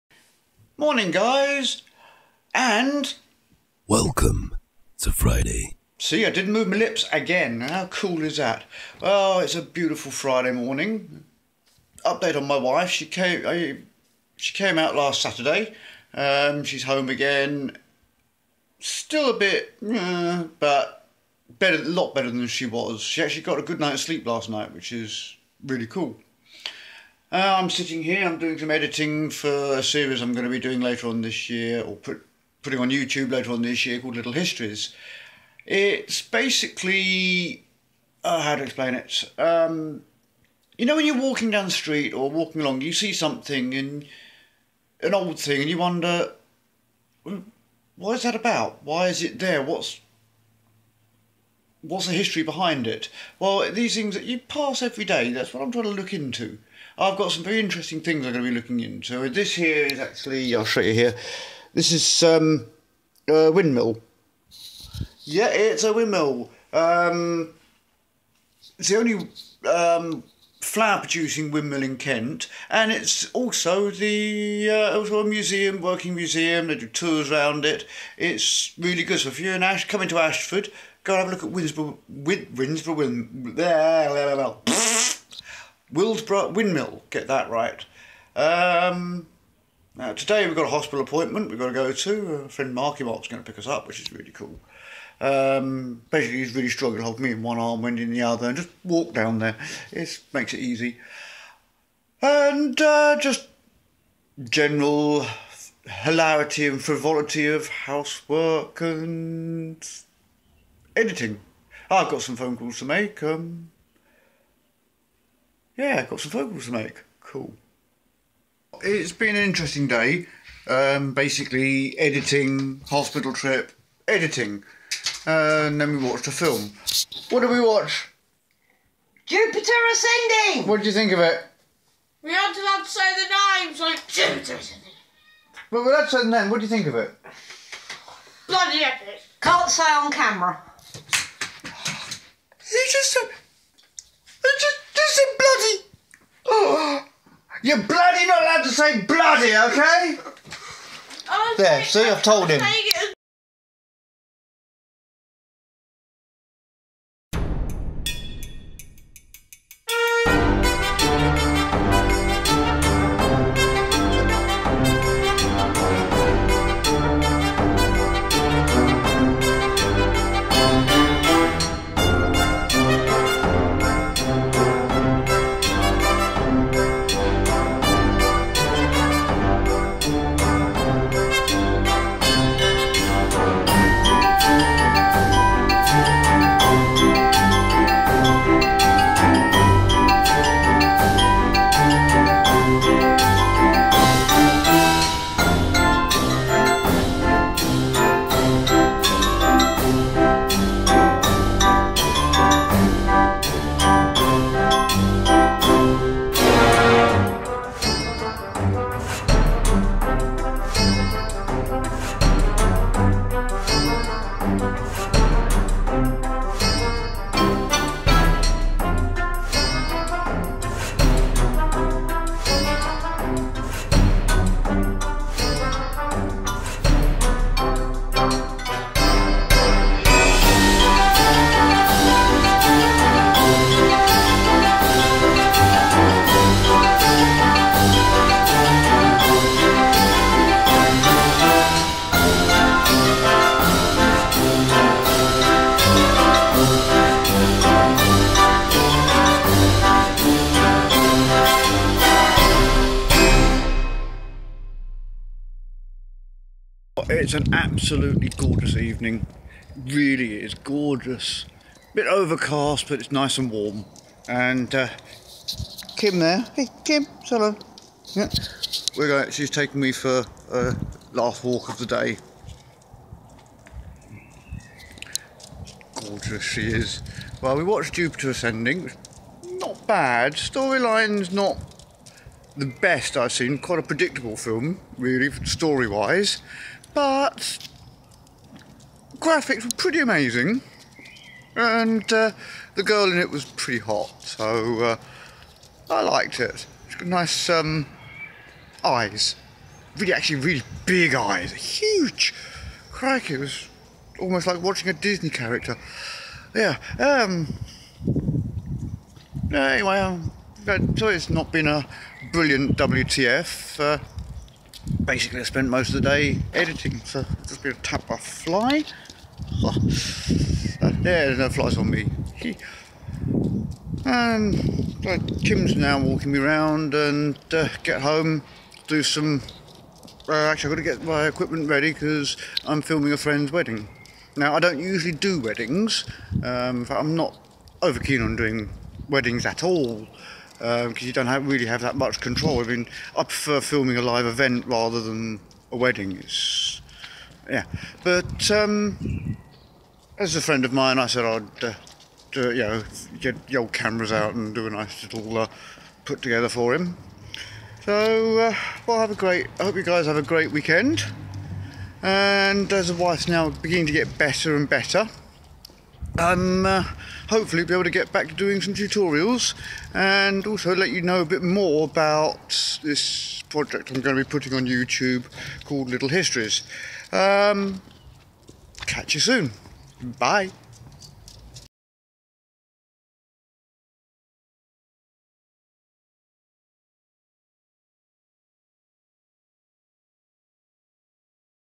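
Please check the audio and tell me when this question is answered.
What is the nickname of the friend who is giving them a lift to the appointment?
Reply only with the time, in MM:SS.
01:32.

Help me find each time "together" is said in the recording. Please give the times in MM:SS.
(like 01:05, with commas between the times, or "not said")
05:56.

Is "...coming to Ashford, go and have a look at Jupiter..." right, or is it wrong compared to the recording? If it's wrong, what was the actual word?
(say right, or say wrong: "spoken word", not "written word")
wrong: "Winsborough", not "Jupiter".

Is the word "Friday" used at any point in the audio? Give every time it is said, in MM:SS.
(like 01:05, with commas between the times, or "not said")
00:05, 00:10.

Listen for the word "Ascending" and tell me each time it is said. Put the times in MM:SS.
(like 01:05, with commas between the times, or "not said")
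02:09, 02:14, 04:38.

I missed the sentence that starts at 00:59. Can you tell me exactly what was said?
This here is actually, I'll show you here.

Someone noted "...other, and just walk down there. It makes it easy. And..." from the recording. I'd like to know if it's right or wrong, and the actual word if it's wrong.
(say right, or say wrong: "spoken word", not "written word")
right.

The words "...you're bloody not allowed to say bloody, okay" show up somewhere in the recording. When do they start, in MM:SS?
02:27.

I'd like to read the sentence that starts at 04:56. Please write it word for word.
It's got nice um, eyes, really, actually, really big eyes, huge.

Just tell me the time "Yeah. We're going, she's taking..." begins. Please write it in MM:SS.
04:28.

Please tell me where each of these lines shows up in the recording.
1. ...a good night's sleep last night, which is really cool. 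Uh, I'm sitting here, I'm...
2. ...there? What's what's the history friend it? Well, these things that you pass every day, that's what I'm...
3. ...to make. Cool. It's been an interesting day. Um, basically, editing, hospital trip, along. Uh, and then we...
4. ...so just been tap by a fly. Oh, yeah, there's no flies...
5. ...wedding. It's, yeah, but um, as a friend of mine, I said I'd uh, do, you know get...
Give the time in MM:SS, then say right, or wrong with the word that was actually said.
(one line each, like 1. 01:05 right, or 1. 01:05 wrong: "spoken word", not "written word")
1. 00:23 right
2. 00:49 wrong: "behind", not "friend"
3. 01:56 wrong: "editing", not "along"
4. 05:17 right
5. 05:45 right.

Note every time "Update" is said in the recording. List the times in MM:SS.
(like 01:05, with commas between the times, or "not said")
00:12.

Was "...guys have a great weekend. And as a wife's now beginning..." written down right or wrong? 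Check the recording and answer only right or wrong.
right.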